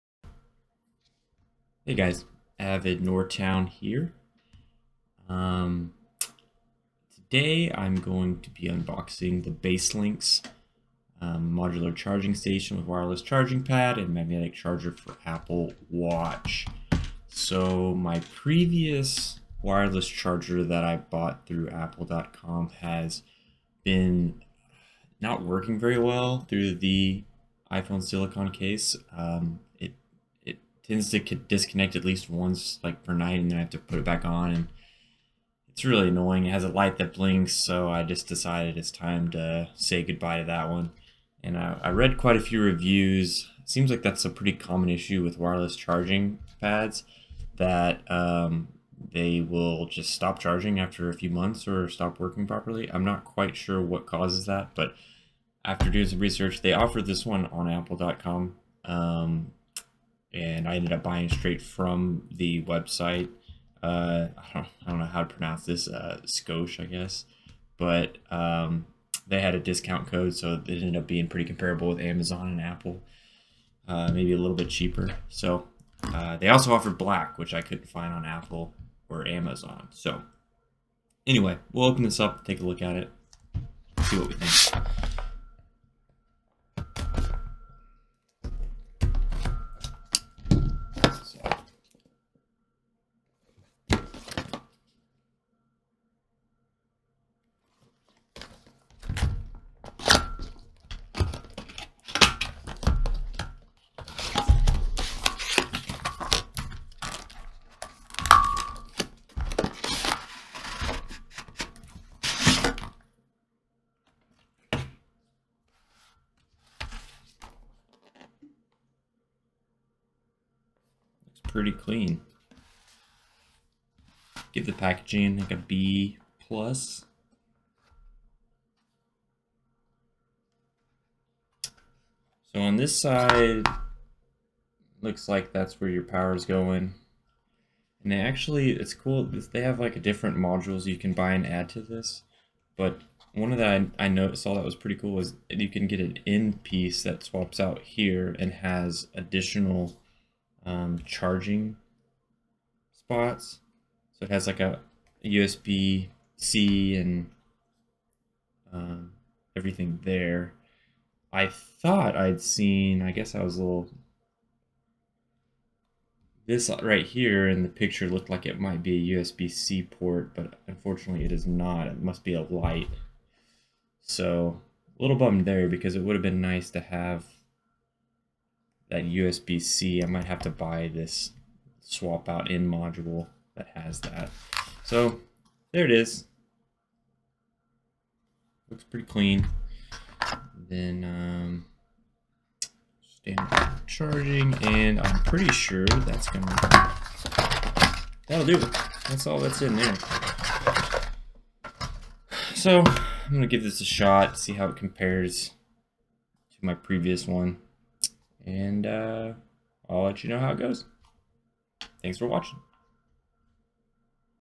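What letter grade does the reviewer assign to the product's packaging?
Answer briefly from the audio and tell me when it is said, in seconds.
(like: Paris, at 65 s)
B plus, at 125 s.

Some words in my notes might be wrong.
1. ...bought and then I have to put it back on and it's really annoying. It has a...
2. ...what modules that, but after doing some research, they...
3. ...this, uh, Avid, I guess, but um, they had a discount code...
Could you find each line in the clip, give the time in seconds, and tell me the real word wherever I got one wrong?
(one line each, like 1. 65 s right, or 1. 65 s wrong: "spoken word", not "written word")
1. 33 s wrong: "night", not "bought"
2. 53 s wrong: "causes", not "modules"
3. 65 s wrong: "Scosh", not "Avid".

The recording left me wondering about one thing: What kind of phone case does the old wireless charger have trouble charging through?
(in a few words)
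iPhone silicone case.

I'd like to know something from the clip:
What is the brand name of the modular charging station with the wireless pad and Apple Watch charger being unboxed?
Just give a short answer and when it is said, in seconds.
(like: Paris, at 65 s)
BaseLynx, at 9 s.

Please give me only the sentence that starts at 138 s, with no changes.
And they actually, it's cool, they have like a different modules you can buy and add to this.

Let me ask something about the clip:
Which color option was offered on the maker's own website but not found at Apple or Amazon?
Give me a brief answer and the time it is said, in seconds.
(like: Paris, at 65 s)
Black, at 76 s.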